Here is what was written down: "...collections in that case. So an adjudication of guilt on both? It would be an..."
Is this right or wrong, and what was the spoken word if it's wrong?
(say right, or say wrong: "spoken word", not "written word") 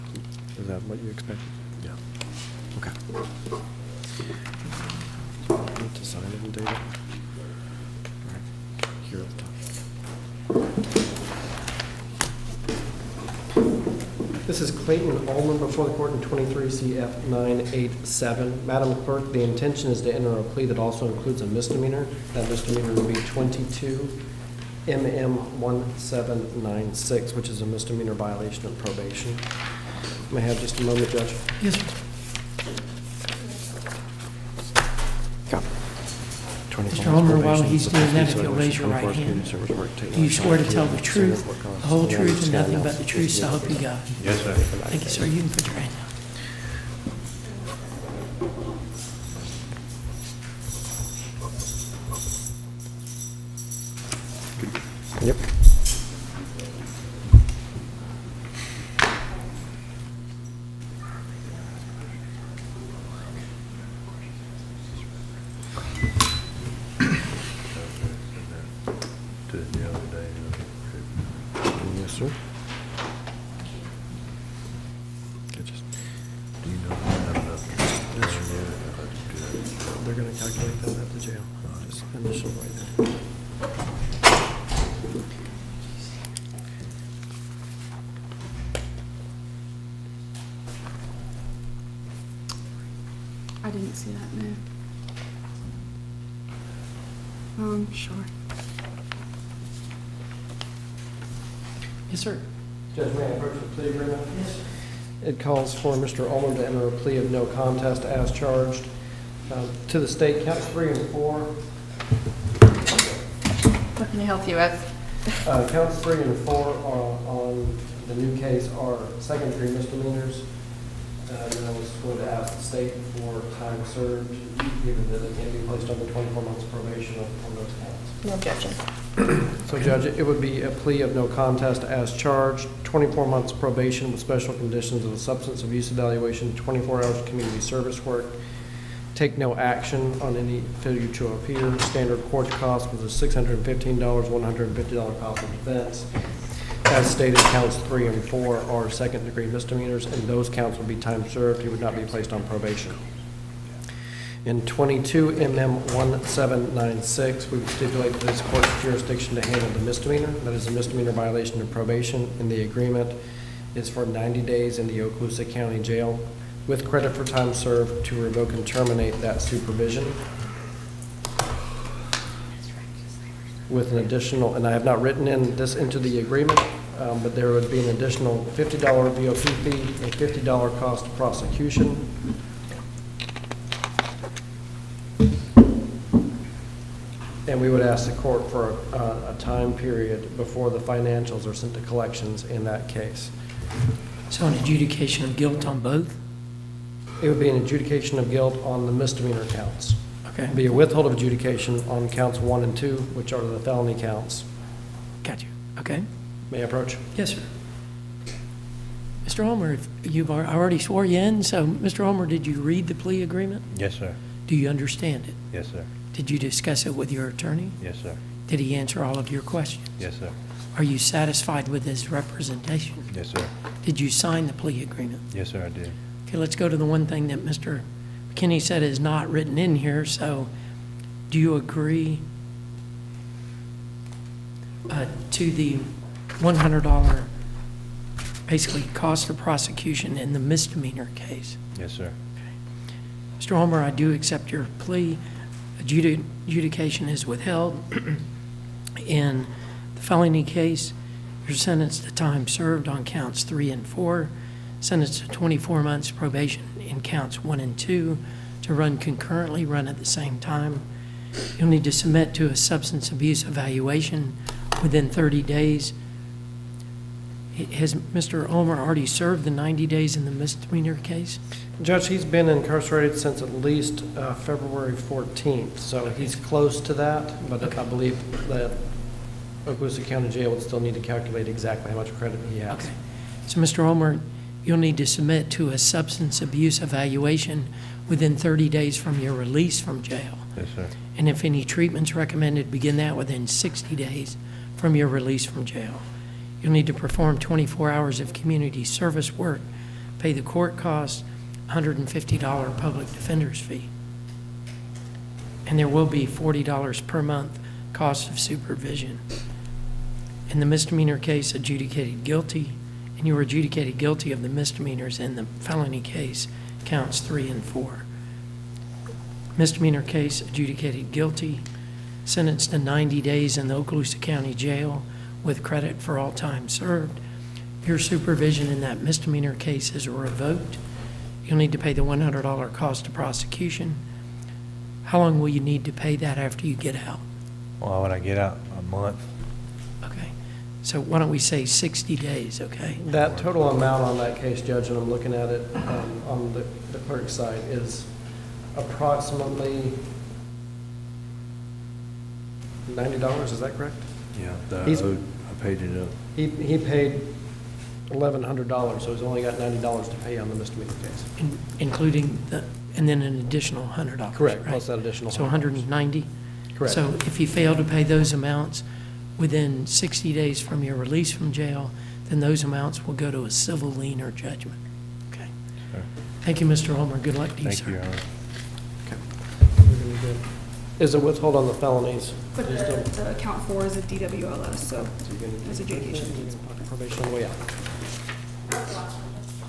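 right.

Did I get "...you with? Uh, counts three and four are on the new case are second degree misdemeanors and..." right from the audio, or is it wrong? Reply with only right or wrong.
right.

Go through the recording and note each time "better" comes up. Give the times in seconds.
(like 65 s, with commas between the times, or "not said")
not said.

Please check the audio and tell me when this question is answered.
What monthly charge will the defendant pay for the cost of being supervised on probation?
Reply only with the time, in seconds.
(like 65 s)
306 s.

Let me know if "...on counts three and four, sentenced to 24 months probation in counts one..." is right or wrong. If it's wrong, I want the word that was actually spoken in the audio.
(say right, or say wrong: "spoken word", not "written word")
right.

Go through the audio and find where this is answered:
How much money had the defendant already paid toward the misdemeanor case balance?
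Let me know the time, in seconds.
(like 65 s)
358 s.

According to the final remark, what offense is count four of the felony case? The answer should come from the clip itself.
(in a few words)
DWLS.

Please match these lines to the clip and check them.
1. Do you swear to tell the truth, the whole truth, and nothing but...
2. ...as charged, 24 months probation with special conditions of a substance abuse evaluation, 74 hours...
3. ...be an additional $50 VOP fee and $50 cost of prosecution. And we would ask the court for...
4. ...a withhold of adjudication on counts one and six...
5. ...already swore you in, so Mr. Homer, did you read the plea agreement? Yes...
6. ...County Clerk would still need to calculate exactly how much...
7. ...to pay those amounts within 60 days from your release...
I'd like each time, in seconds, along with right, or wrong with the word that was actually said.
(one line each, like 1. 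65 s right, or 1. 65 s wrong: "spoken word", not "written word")
1. 39 s right
2. 131 s wrong: "24", not "74"
3. 177 s right
4. 200 s wrong: "two", not "six"
5. 210 s right
6. 280 s wrong: "Jail", not "Clerk"
7. 367 s right.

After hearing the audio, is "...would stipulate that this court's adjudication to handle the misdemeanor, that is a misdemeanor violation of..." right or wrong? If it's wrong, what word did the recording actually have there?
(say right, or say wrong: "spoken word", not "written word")
wrong: "jurisdiction", not "adjudication".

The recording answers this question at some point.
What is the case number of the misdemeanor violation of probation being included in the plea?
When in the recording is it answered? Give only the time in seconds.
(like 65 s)
23 s.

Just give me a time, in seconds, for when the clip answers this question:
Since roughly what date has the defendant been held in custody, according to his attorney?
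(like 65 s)
274 s.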